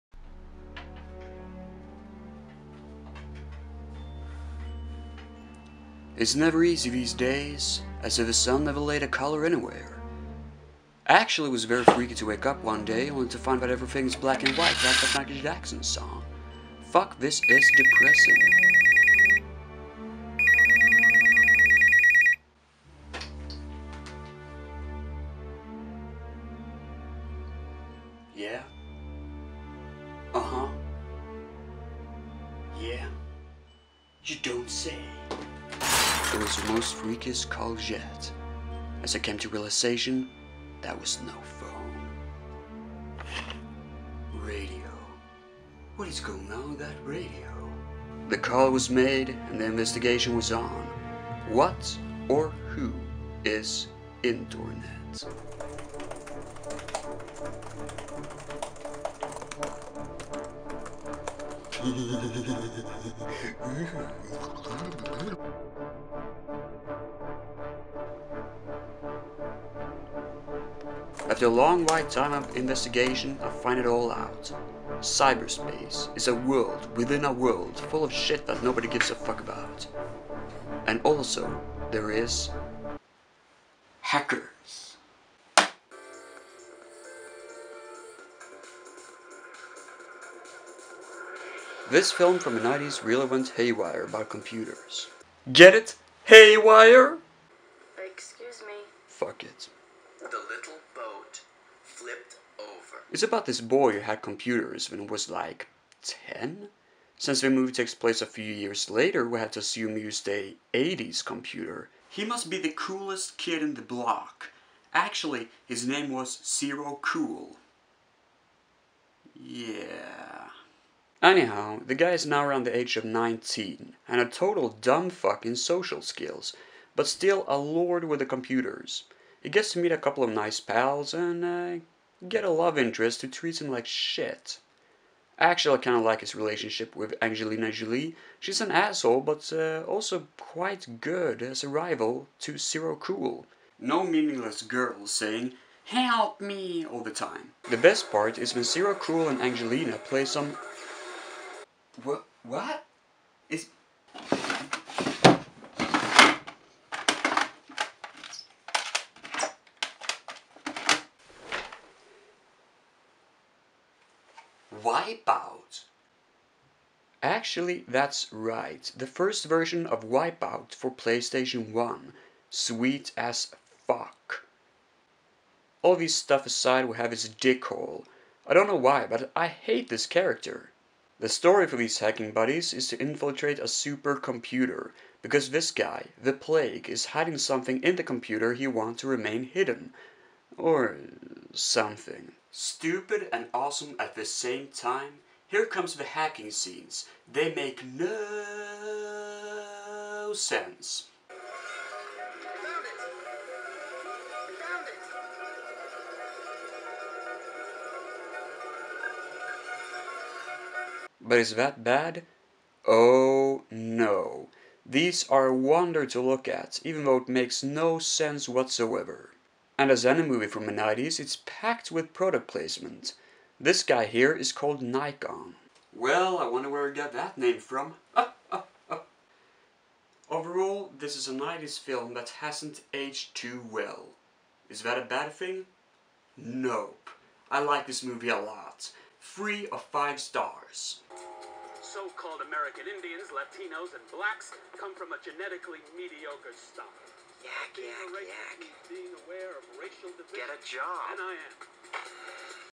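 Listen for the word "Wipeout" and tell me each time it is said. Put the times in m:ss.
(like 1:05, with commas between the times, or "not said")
2:32, 2:50.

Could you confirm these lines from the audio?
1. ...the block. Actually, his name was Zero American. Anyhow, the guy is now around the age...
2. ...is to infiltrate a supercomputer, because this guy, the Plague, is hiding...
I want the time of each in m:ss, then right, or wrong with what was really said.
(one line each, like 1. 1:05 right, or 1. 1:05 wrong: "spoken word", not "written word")
1. 1:53 wrong: "Cool", not "American"
2. 3:02 right.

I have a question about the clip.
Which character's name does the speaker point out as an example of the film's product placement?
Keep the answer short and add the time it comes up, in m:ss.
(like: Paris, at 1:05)
Nikon, at 3:44.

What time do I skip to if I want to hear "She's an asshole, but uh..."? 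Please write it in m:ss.
2:18.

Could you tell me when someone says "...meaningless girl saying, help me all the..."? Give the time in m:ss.
2:24.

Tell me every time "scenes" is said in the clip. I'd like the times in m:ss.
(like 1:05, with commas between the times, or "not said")
3:16.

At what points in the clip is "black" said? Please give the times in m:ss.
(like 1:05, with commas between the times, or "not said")
0:14, 4:04.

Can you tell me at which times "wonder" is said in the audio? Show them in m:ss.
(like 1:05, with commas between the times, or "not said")
3:35, 3:46.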